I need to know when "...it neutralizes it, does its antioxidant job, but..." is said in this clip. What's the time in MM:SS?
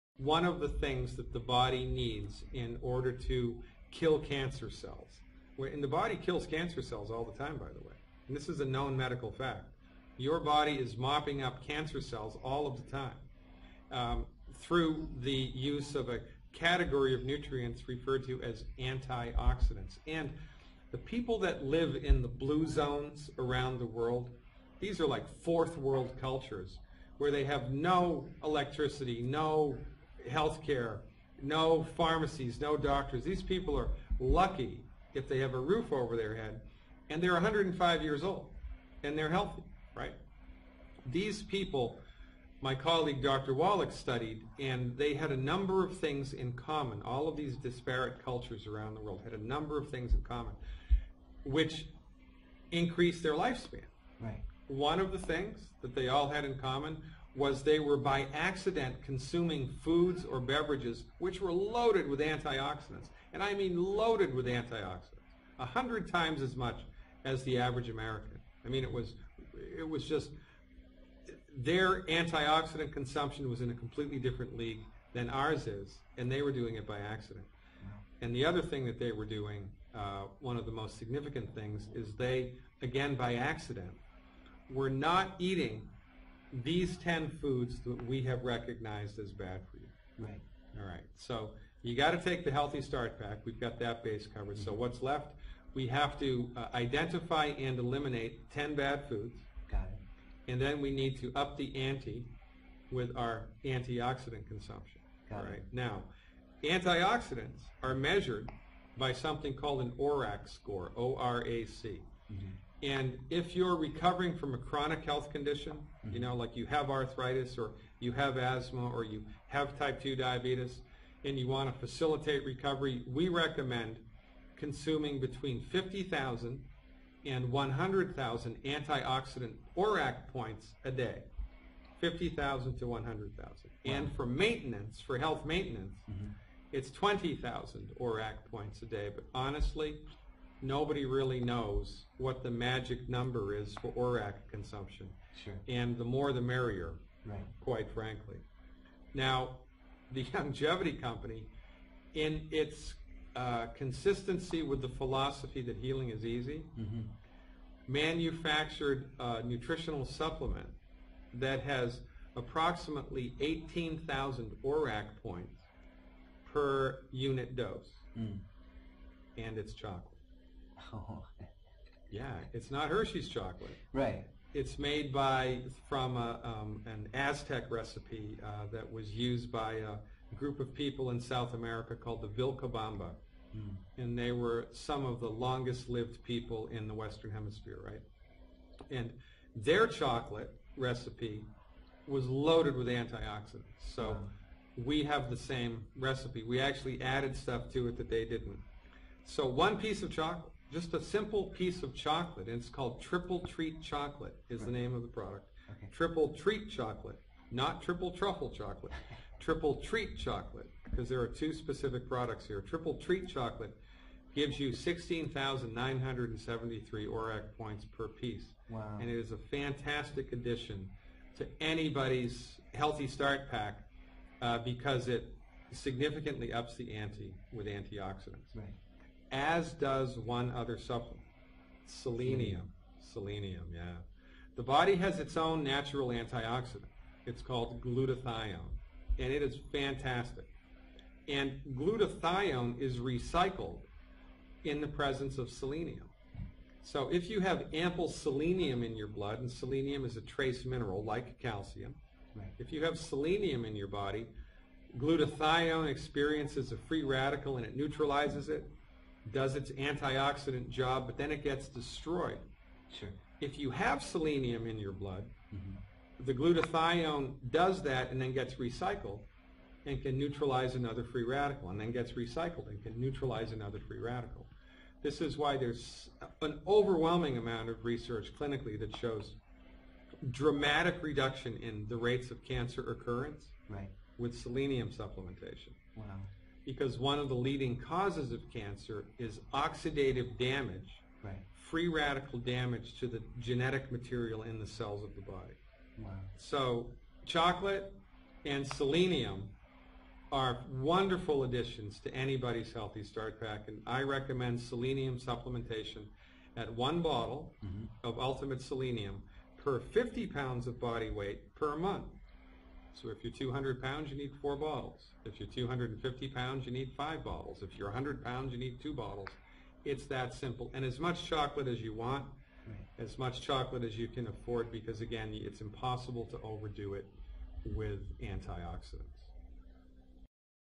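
04:17.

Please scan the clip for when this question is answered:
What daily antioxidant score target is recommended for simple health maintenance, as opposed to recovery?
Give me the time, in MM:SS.
02:16.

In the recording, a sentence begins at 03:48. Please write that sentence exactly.
Right as does one other supplement, selenium.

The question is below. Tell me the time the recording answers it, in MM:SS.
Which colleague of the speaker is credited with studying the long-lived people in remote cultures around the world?
00:43.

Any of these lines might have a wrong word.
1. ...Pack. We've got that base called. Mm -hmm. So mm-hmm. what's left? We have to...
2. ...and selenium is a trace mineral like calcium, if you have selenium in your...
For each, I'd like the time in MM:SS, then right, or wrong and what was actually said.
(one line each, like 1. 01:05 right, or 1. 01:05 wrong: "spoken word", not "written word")
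1. 01:33 wrong: "covered", not "called"
2. 04:09 right.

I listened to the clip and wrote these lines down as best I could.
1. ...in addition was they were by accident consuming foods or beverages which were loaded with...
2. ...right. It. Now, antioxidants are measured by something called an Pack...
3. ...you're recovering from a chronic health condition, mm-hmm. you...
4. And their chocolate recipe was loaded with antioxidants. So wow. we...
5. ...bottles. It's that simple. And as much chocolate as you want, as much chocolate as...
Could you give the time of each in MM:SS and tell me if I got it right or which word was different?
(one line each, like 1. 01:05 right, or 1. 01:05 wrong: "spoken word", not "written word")
1. 00:56 wrong: "common", not "addition"
2. 01:45 wrong: "ORAC", not "Pack"
3. 01:53 right
4. 03:08 right
5. 05:18 right.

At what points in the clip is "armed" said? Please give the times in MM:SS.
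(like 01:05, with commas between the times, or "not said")
not said.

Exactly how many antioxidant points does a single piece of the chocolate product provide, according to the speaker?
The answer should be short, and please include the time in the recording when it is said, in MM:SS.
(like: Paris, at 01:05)
16,973, at 03:34.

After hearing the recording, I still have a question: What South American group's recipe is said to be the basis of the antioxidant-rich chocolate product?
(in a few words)
the Vilcabamba.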